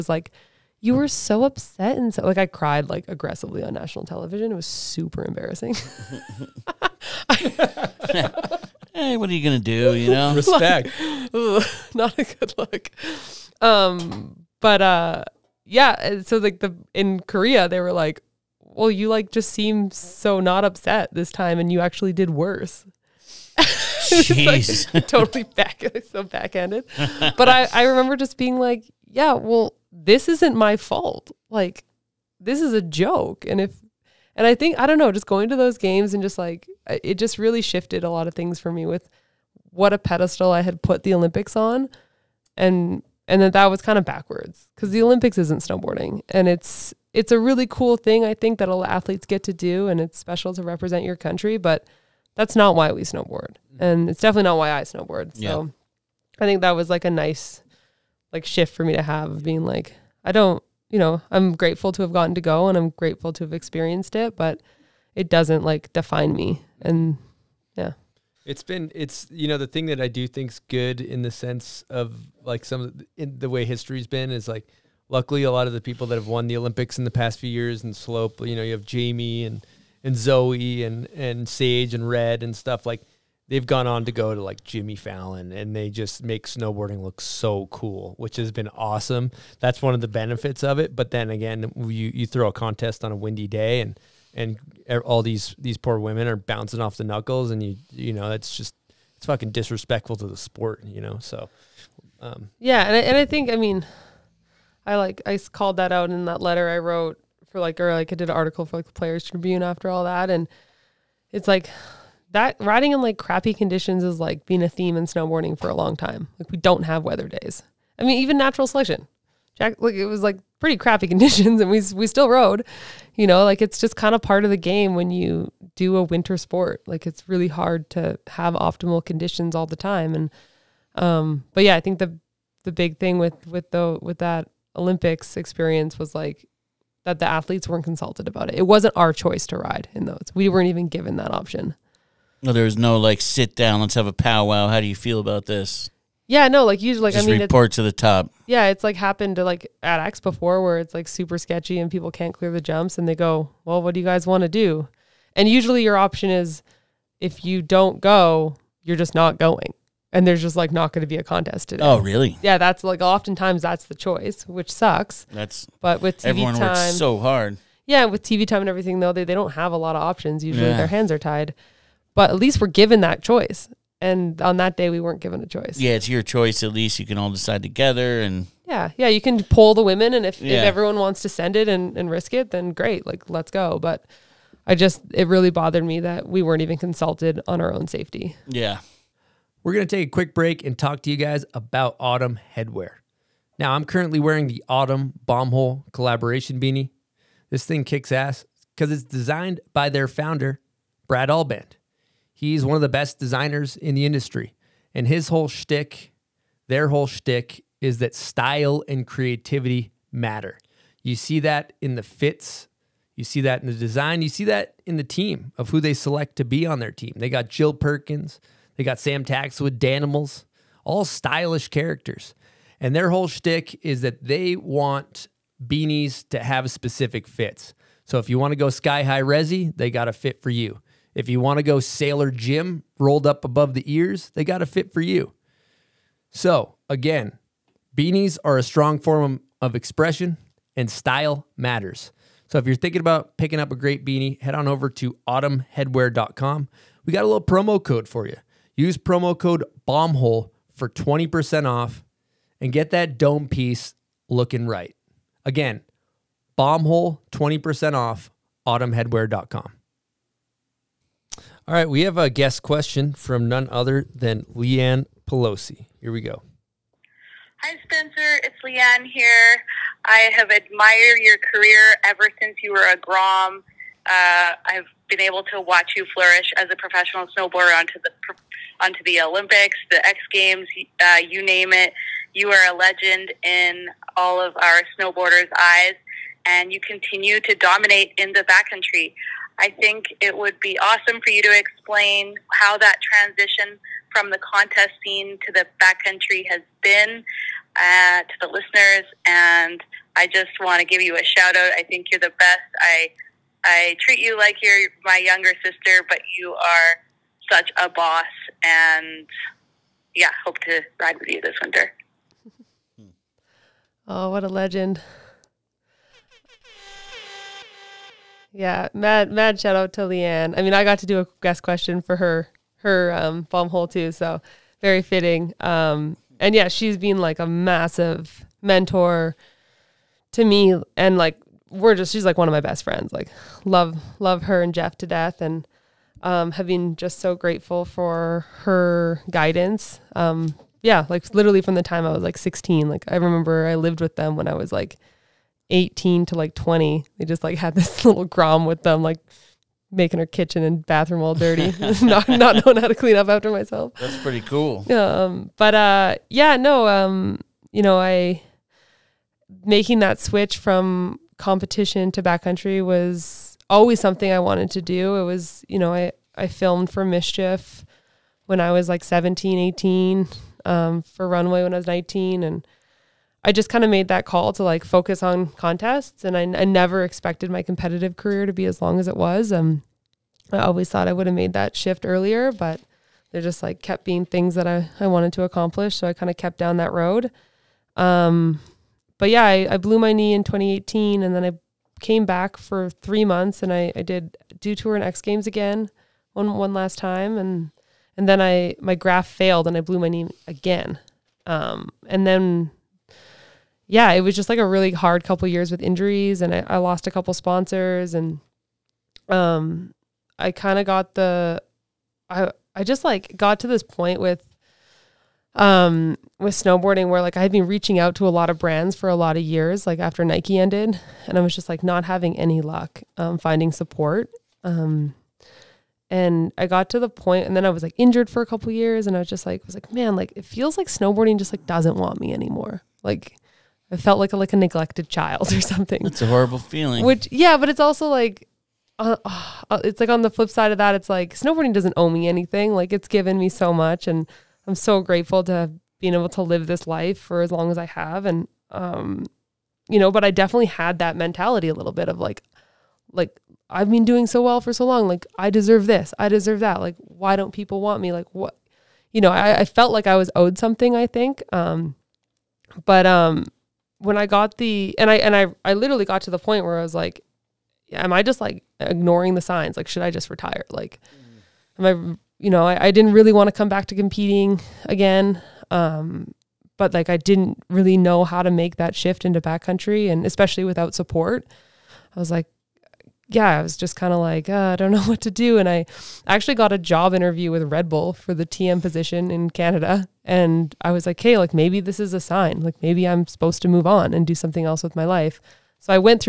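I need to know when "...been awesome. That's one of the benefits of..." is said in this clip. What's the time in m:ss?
1:28.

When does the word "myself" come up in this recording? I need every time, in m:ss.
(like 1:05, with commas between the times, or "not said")
5:53.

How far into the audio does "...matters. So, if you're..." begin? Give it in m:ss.
4:01.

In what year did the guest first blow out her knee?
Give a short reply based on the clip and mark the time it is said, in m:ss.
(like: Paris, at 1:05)
2018, at 6:30.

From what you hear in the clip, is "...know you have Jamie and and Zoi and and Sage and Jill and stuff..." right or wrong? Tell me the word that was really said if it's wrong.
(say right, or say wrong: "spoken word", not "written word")
wrong: "Red", not "Jill".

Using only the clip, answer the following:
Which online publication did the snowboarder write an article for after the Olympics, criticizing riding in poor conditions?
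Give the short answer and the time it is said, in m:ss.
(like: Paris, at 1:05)
The Players Tribune, at 1:48.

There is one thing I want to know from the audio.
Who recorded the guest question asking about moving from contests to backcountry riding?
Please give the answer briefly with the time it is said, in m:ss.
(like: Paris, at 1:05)
Leanne Pelosi, at 4:24.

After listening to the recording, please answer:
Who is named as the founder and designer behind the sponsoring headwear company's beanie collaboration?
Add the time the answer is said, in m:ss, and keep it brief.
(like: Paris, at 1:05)
Brad Alband, at 3:21.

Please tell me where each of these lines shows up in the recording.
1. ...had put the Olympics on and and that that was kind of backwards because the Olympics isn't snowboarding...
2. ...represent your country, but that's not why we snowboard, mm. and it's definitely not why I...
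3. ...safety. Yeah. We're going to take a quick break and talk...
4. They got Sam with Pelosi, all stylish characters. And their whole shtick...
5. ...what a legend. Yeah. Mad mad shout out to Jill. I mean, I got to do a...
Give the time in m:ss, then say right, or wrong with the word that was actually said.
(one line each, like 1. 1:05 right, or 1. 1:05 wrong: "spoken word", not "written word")
1. 0:40 right
2. 0:50 right
3. 3:07 right
4. 3:38 wrong: "Danimals", not "Pelosi"
5. 5:14 wrong: "Leanne", not "Jill".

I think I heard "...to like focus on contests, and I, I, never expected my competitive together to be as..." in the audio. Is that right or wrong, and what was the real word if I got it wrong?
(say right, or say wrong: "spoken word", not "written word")
wrong: "career", not "together".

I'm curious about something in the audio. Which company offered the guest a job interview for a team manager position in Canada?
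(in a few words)
Red Bull.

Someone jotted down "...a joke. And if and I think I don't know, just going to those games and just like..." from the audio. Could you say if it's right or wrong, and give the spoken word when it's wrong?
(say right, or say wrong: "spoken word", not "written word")
right.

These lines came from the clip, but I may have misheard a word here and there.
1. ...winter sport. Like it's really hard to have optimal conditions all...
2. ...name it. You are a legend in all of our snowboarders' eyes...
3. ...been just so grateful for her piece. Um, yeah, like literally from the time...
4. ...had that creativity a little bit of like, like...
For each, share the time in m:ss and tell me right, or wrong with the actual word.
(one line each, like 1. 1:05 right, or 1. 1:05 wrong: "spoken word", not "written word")
1. 2:06 right
2. 4:41 right
3. 5:36 wrong: "guidance", not "piece"
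4. 7:30 wrong: "mentality", not "creativity".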